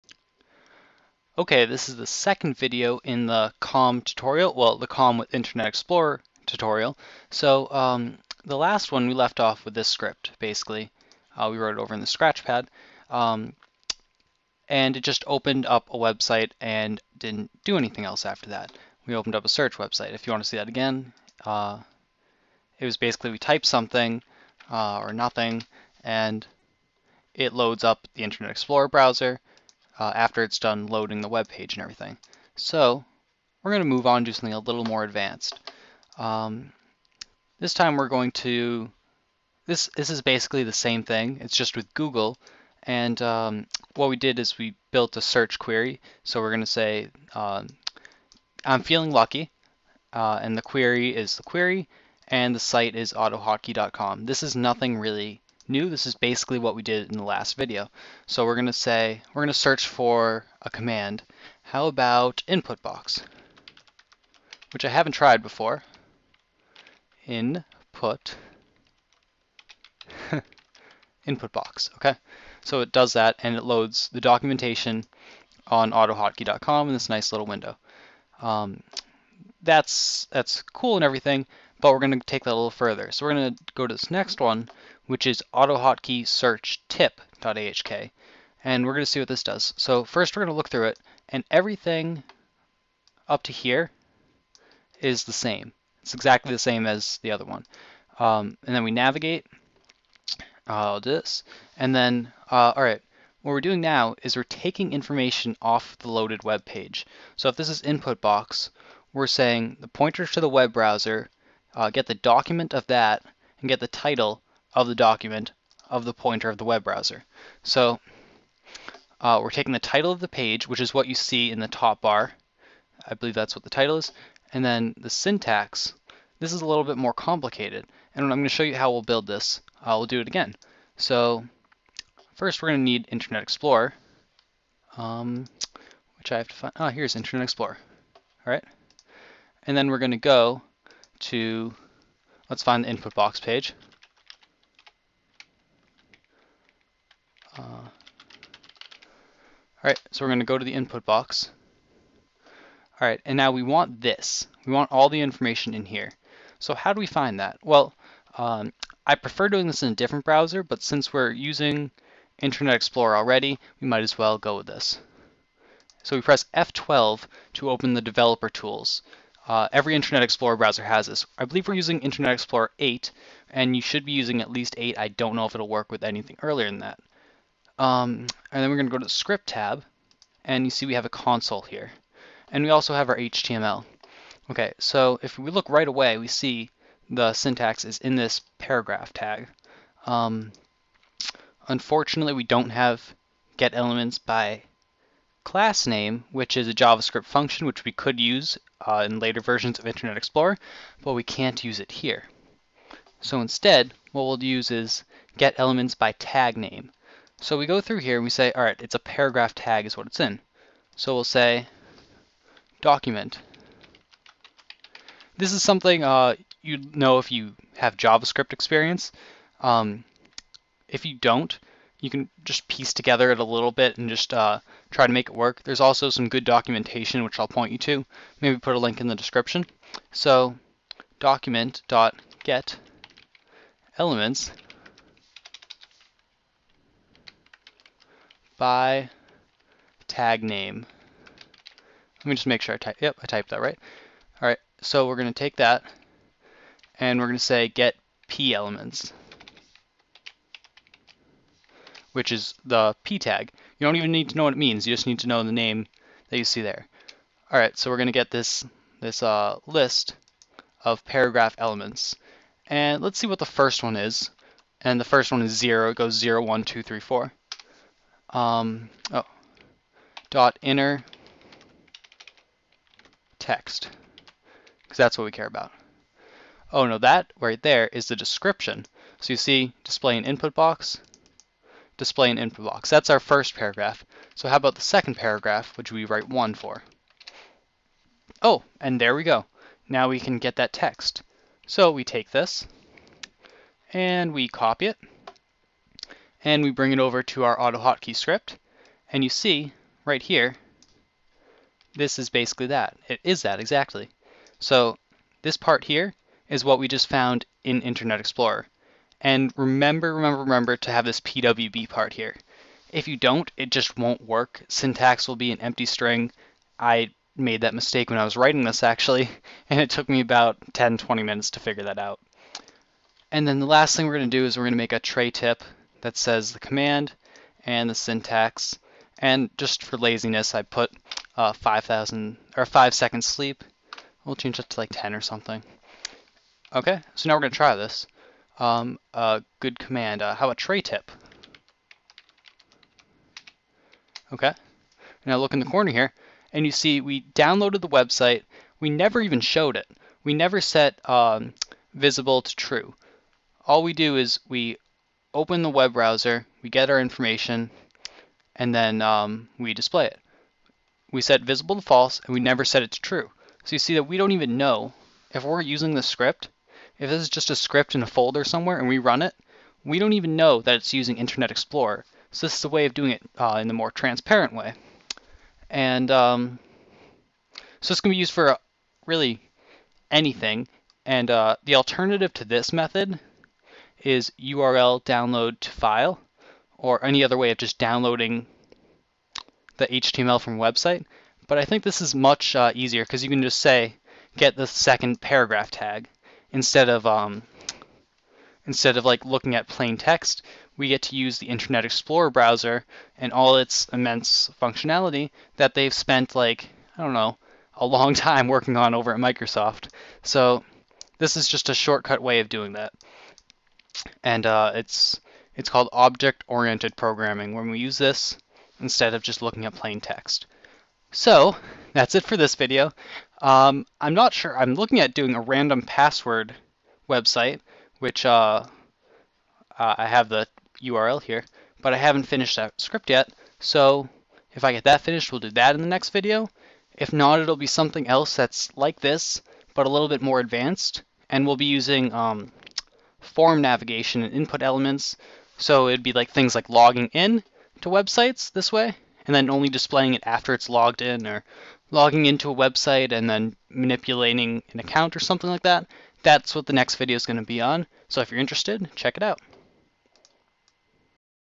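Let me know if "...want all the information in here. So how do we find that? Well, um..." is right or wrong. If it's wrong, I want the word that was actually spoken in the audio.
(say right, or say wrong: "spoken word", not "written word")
right.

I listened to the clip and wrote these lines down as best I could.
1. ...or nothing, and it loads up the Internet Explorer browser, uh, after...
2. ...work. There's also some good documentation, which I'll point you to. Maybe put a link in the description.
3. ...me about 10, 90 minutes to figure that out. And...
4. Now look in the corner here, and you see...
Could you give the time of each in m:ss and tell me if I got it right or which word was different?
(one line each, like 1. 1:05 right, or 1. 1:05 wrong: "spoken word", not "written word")
1. 0:24 right
2. 3:45 right
3. 5:20 wrong: "20", not "90"
4. 5:45 right.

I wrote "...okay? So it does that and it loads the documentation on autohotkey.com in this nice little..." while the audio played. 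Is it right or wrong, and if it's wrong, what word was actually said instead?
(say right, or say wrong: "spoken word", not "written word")
right.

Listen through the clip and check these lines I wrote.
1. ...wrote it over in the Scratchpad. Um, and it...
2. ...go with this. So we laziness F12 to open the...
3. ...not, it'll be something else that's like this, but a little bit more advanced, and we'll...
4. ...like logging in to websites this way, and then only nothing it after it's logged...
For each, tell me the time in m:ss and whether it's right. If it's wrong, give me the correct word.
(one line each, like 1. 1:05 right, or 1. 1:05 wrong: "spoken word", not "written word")
1. 0:11 right
2. 2:44 wrong: "press", not "laziness"
3. 7:17 right
4. 7:26 wrong: "displaying", not "nothing".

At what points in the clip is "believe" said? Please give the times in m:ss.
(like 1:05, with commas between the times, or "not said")
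2:03, 2:51.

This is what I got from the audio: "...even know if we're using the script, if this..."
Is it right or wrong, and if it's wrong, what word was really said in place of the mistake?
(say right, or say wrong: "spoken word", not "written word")
right.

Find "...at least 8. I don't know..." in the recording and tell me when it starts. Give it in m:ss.
2:54.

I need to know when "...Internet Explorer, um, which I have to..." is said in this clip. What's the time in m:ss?
2:13.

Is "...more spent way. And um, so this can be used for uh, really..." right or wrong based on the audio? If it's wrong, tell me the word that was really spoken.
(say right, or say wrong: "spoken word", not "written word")
wrong: "transparent", not "spent".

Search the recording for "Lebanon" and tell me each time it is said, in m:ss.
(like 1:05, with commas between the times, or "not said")
not said.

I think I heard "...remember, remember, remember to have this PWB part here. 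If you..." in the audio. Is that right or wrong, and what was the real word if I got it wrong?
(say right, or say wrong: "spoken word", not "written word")
right.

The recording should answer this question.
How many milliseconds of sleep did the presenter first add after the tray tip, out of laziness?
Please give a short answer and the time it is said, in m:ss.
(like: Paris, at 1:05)
5000, at 5:31.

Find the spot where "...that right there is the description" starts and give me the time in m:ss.
4:36.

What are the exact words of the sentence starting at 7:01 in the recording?
So that's it for this video.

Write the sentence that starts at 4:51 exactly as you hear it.
So we take this and we copy it and we bring it over to our auto hotkey script.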